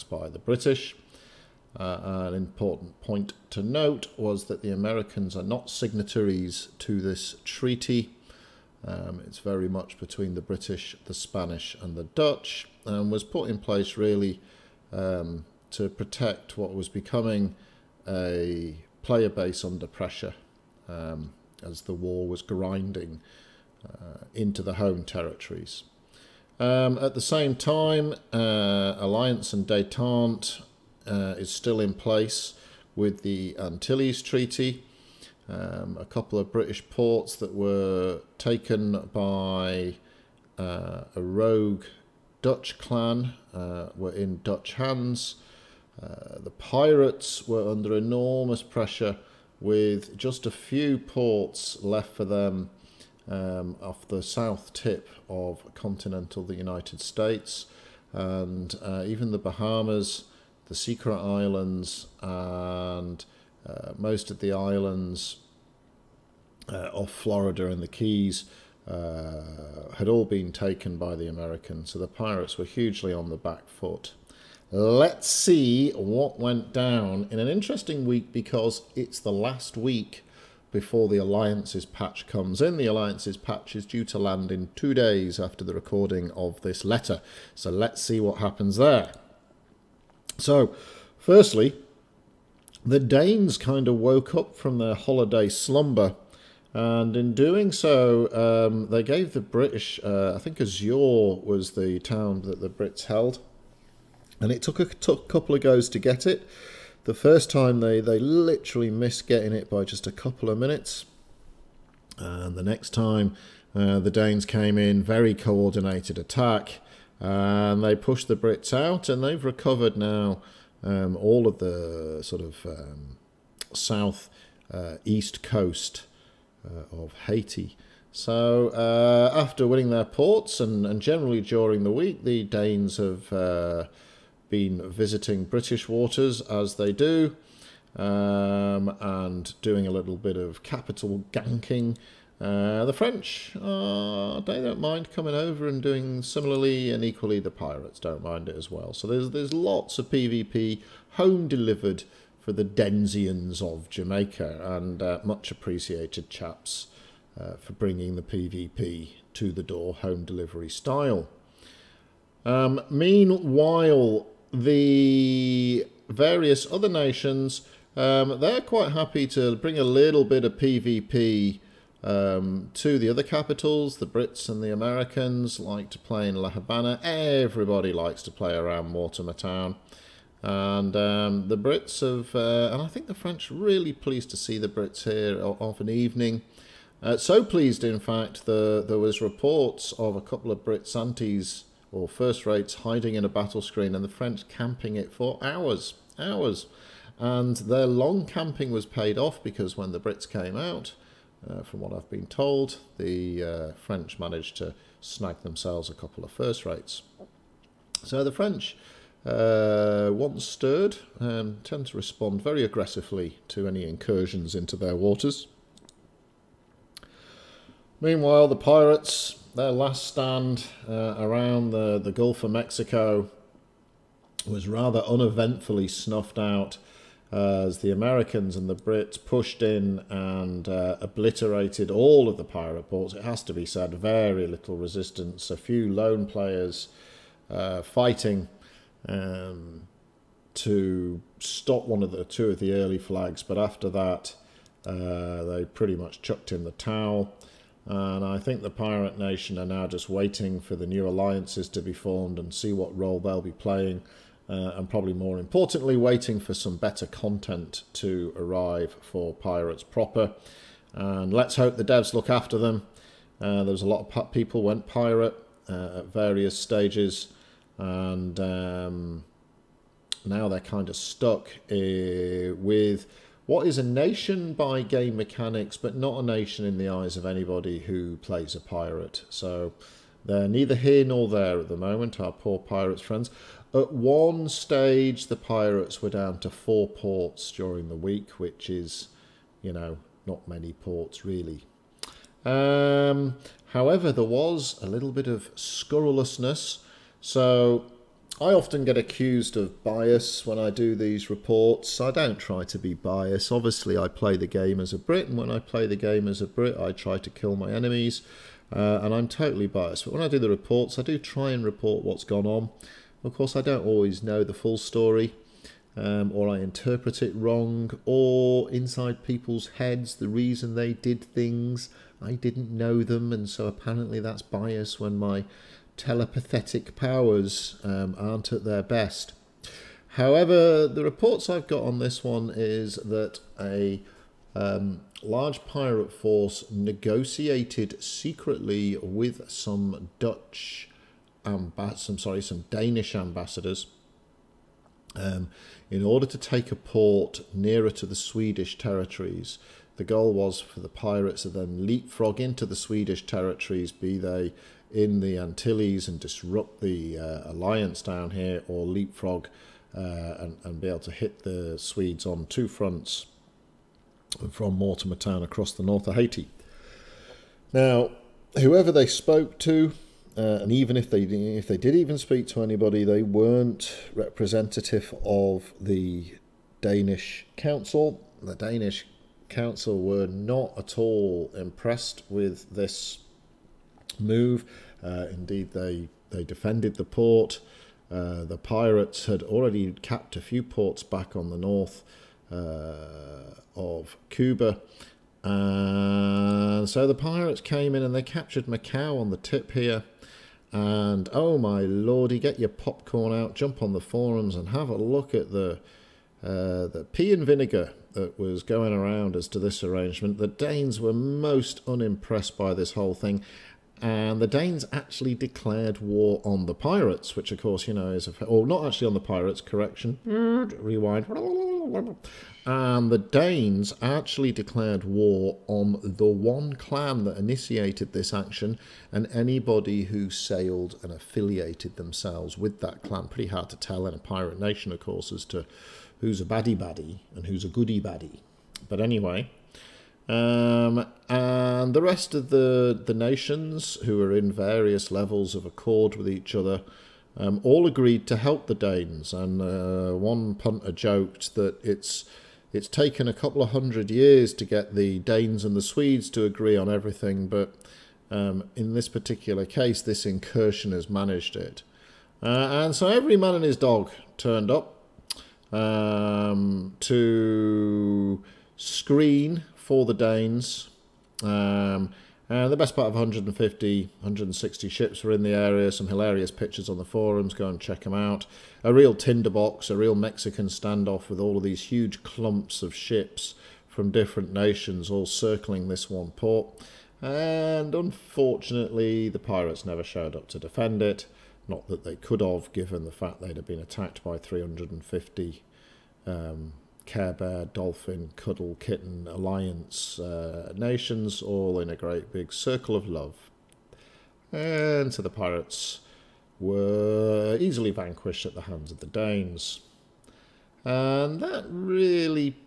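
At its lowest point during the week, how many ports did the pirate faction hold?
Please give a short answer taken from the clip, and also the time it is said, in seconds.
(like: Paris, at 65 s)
4, at 286 s.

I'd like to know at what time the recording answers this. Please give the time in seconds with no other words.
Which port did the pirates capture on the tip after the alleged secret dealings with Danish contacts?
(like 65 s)
398 s.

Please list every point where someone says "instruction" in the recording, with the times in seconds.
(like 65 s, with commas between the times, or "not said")
not said.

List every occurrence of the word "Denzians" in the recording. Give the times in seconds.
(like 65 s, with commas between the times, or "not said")
152 s.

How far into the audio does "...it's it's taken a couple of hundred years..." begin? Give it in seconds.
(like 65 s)
451 s.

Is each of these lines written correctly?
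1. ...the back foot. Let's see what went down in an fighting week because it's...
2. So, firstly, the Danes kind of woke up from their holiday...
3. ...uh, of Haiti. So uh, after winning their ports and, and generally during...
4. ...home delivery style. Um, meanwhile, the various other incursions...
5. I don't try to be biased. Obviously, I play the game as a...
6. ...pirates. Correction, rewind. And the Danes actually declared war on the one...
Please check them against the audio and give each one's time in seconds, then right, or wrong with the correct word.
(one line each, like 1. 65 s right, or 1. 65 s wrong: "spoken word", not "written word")
1. 73 s wrong: "interesting", not "fighting"
2. 90 s right
3. 126 s right
4. 159 s wrong: "nations", not "incursions"
5. 301 s right
6. 419 s right.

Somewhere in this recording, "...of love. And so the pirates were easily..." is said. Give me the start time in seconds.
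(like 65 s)
502 s.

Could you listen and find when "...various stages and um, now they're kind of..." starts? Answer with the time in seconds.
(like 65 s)
266 s.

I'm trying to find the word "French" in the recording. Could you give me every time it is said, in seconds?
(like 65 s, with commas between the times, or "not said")
142 s, 183 s, 194 s, 203 s, 208 s.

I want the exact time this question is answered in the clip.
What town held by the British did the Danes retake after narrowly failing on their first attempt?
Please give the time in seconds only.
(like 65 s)
100 s.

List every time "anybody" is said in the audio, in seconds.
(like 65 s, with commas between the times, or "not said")
277 s, 372 s, 429 s.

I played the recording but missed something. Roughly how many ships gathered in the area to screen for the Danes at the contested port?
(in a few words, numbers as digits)
150-160.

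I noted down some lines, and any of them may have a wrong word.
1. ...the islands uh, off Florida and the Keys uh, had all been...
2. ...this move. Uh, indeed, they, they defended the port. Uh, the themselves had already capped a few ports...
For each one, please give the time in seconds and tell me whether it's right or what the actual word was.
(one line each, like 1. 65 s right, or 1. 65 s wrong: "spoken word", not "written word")
1. 64 s right
2. 382 s wrong: "pirates", not "themselves".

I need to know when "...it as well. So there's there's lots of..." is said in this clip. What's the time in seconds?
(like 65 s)
148 s.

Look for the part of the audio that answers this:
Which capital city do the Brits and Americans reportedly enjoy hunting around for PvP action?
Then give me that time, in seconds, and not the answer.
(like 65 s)
176 s.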